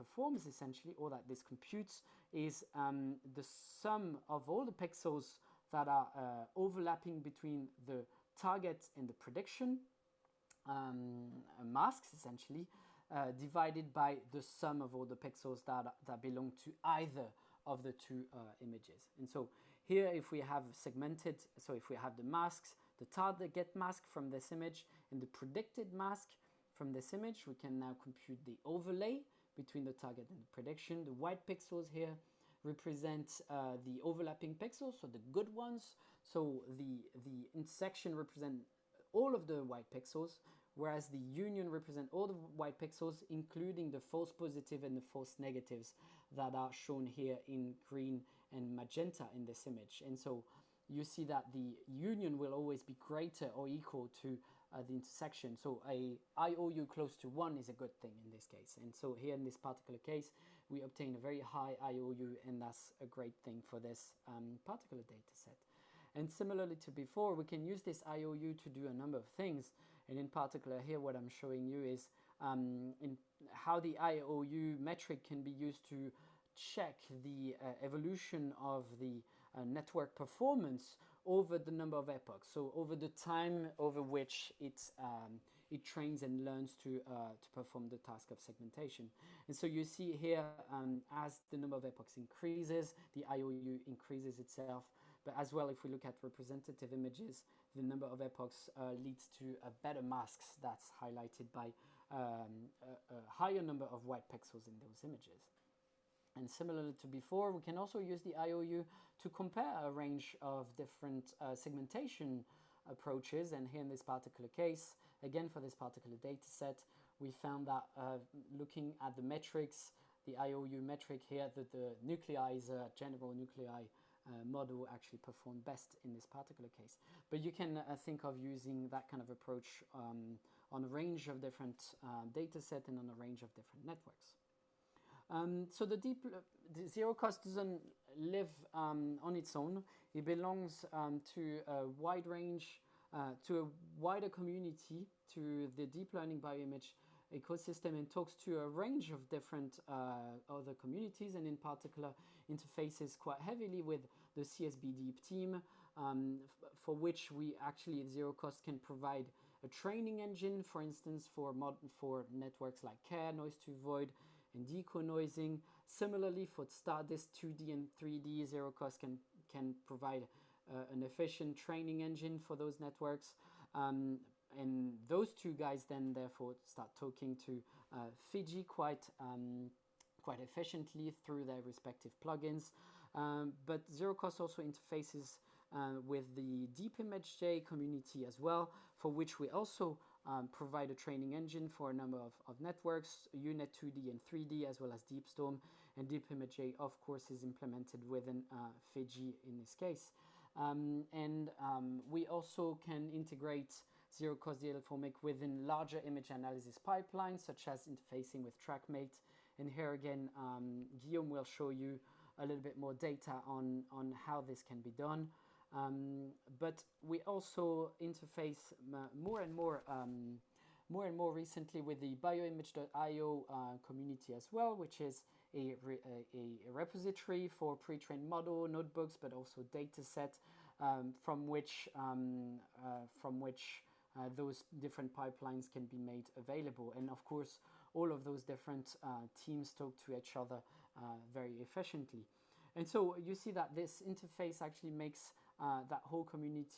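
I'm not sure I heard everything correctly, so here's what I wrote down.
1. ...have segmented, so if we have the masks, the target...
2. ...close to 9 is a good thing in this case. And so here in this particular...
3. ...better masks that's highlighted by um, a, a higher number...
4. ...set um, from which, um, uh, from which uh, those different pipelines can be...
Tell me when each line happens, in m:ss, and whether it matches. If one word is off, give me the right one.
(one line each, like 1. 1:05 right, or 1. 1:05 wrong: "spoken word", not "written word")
1. 0:20 right
2. 0:56 wrong: "1", not "9"
3. 1:39 right
4. 3:50 right.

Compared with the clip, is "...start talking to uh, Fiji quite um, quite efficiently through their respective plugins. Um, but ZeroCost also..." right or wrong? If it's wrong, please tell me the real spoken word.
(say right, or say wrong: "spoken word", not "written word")
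right.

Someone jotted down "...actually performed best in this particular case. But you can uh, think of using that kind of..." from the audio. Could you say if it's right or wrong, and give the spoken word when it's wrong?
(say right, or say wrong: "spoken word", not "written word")
right.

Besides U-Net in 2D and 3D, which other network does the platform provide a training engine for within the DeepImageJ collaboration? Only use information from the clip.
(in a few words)
DeepStorm.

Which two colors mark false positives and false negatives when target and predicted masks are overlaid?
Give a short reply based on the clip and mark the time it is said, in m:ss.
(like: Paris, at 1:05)
green and magenta, at 0:47.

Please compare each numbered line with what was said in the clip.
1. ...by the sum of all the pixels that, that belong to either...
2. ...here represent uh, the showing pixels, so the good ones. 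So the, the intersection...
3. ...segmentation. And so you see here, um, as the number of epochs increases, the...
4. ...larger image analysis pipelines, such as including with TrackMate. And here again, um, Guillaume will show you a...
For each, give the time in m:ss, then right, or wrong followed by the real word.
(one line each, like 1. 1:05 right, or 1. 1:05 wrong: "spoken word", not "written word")
1. 0:13 right
2. 0:31 wrong: "overlapping", not "showing"
3. 1:28 right
4. 3:25 wrong: "interfacing", not "including".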